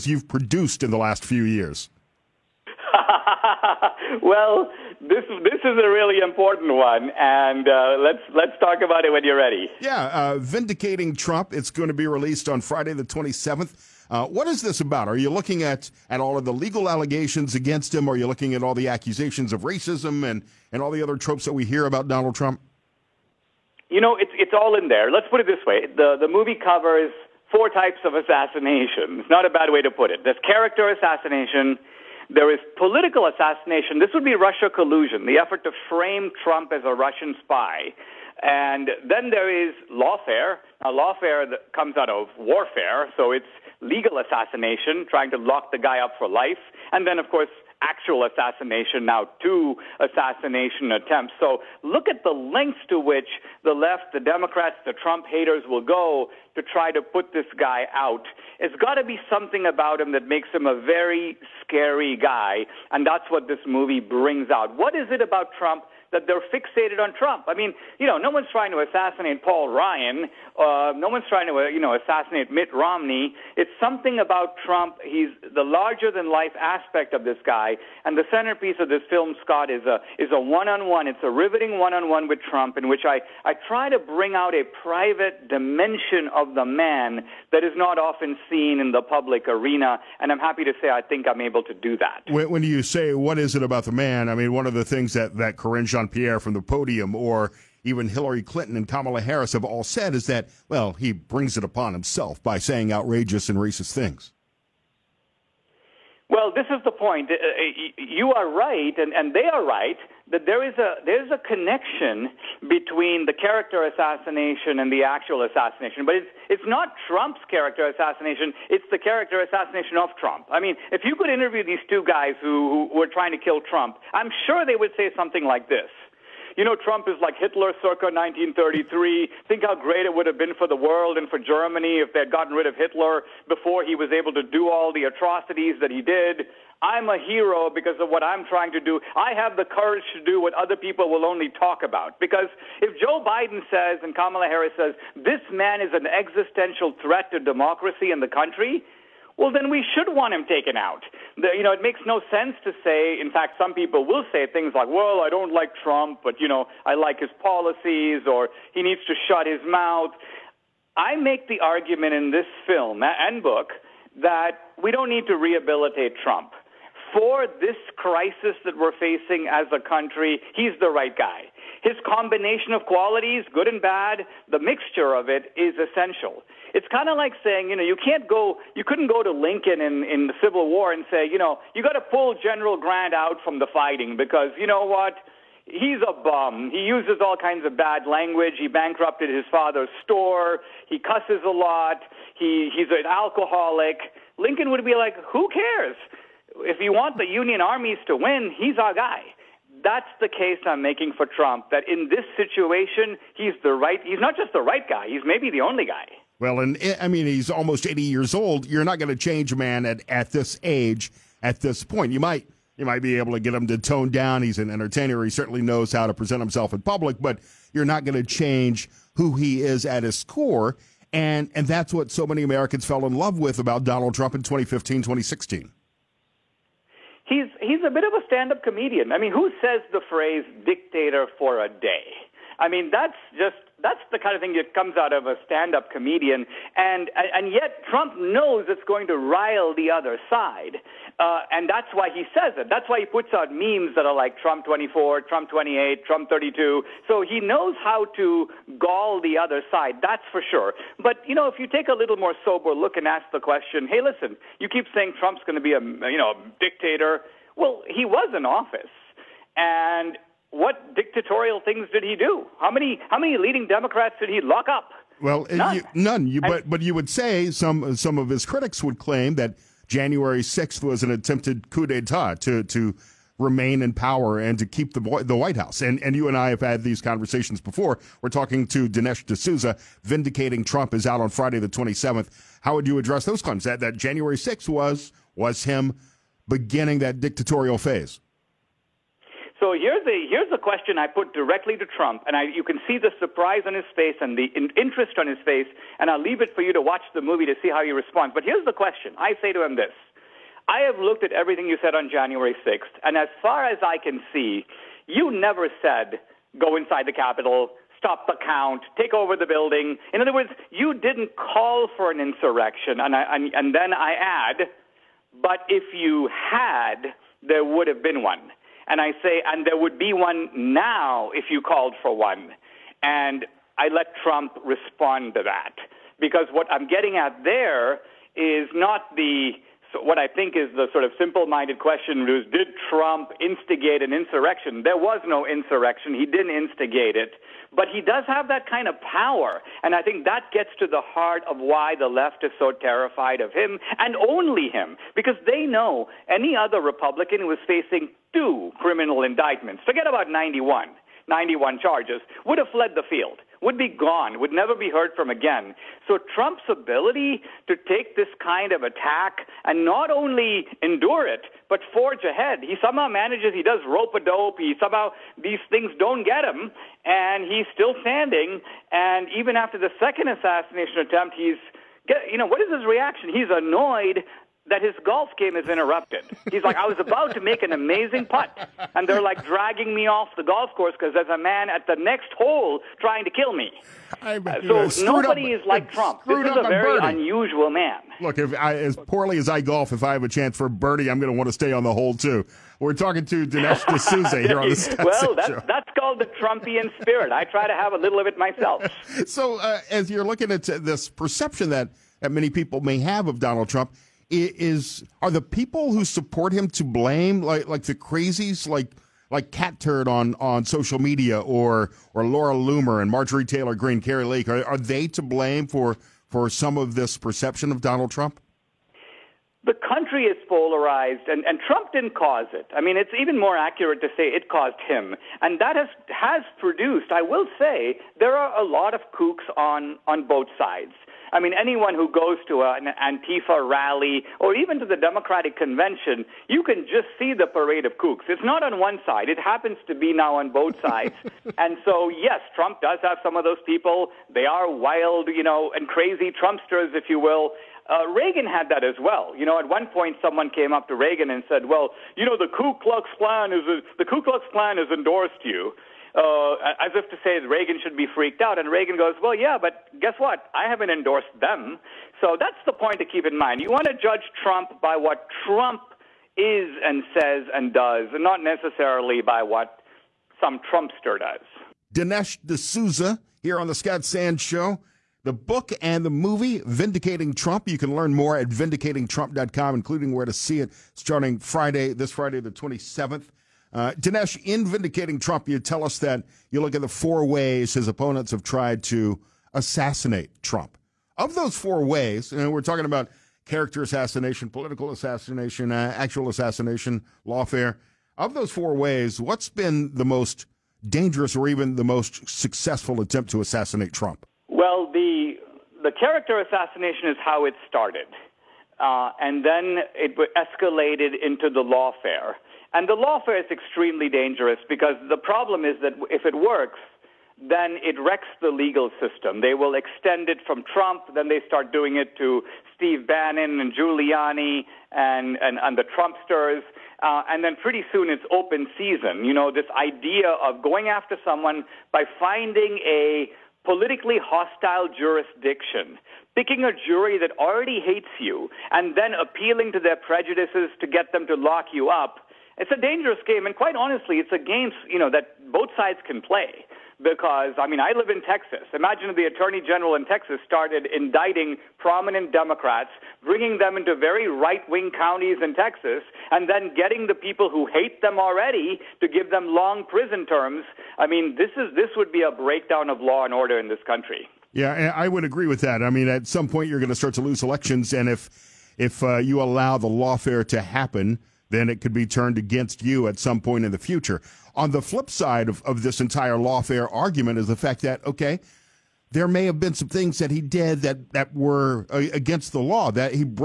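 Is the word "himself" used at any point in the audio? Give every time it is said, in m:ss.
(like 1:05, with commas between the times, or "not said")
1:41, 3:36.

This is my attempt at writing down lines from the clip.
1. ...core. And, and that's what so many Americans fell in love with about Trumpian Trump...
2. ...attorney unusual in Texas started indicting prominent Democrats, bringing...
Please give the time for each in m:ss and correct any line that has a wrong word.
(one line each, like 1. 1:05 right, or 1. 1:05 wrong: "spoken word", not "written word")
1. 3:40 wrong: "Donald", not "Trumpian"
2. 9:09 wrong: "general", not "unusual".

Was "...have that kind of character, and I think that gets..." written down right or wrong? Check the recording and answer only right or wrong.
wrong.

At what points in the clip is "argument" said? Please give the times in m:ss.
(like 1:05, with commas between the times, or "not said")
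2:41, 9:36.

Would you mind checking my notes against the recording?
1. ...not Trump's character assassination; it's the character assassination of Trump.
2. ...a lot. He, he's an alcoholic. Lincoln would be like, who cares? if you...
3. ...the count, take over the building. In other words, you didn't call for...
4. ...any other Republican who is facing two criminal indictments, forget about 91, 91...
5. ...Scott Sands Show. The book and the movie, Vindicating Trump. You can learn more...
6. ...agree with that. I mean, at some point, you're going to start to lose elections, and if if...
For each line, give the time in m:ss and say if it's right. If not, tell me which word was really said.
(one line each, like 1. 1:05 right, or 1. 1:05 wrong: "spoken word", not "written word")
1. 1:56 right
2. 3:11 right
3. 5:08 right
4. 5:46 right
5. 7:53 right
6. 9:25 right.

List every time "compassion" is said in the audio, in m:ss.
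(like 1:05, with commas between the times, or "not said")
not said.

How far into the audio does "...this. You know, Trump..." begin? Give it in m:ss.
2:05.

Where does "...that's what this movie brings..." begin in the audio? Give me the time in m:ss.
1:03.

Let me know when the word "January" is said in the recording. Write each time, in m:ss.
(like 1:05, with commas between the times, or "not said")
4:29, 4:43, 5:02.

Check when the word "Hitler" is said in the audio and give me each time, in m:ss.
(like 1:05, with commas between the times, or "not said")
2:07, 2:12.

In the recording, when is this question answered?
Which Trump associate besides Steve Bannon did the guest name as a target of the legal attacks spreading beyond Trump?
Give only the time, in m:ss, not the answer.
8:43.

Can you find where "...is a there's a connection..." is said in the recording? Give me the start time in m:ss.
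1:50.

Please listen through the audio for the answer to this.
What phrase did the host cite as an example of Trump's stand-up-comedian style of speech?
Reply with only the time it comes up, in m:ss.
3:50.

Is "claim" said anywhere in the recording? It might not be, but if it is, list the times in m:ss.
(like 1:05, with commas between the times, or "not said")
4:28, 4:43.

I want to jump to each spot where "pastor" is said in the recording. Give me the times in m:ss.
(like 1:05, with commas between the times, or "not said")
not said.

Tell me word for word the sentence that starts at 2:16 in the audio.
I'm a hero because of what I'm trying to do.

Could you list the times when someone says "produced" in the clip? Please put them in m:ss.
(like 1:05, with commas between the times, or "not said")
0:00, 7:06.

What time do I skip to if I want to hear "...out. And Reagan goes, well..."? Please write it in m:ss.
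7:38.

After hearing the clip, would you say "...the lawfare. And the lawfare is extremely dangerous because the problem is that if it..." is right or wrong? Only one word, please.
right.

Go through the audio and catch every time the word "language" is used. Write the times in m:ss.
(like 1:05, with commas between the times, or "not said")
3:08.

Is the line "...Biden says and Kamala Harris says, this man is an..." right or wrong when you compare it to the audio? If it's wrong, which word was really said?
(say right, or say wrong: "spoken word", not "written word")
right.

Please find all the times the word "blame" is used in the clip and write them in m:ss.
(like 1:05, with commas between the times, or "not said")
6:46, 6:55.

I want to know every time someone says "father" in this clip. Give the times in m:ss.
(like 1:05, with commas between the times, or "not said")
3:09.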